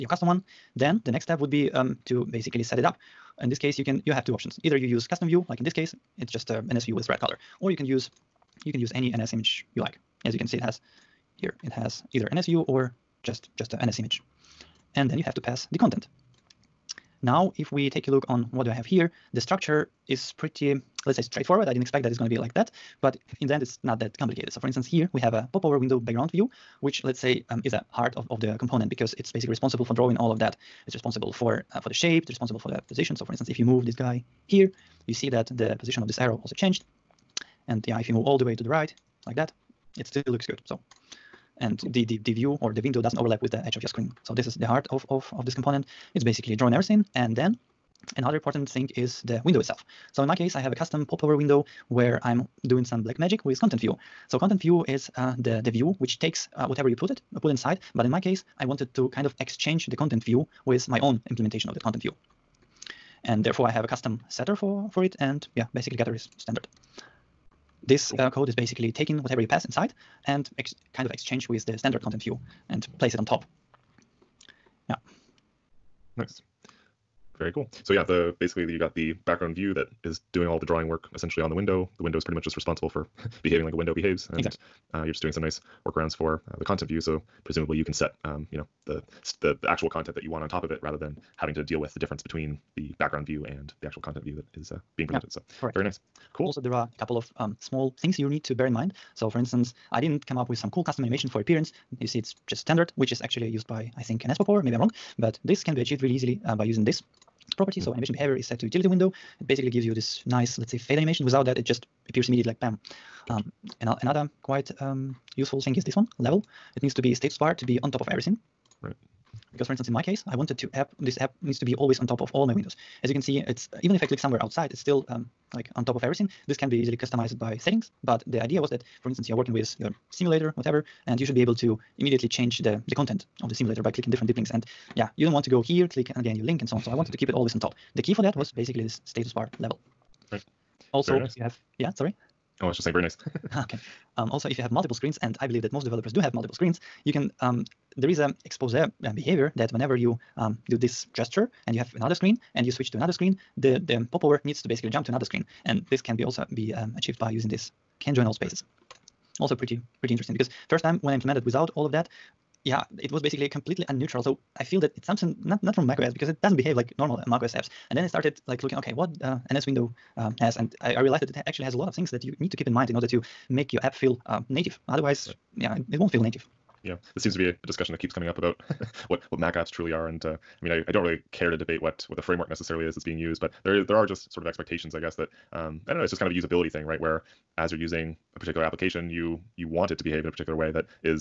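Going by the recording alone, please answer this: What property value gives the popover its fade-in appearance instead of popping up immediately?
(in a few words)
Utility window.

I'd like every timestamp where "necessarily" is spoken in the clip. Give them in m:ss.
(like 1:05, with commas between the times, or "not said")
3:02.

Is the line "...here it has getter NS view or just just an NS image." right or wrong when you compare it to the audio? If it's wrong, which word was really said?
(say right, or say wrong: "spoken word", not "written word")
wrong: "either", not "getter".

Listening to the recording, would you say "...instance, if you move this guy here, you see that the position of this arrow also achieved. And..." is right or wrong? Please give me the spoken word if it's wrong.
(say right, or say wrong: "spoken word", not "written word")
wrong: "changed", not "achieved".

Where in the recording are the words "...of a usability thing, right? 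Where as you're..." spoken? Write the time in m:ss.
3:06.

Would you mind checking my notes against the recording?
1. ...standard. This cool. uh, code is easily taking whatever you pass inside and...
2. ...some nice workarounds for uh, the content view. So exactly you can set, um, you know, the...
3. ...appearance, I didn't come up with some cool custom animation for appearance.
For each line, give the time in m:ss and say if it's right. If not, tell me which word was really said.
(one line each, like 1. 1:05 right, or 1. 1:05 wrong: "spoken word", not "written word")
1. 1:06 wrong: "basically", not "easily"
2. 1:25 wrong: "presumably", not "exactly"
3. 1:39 wrong: "instance", not "appearance".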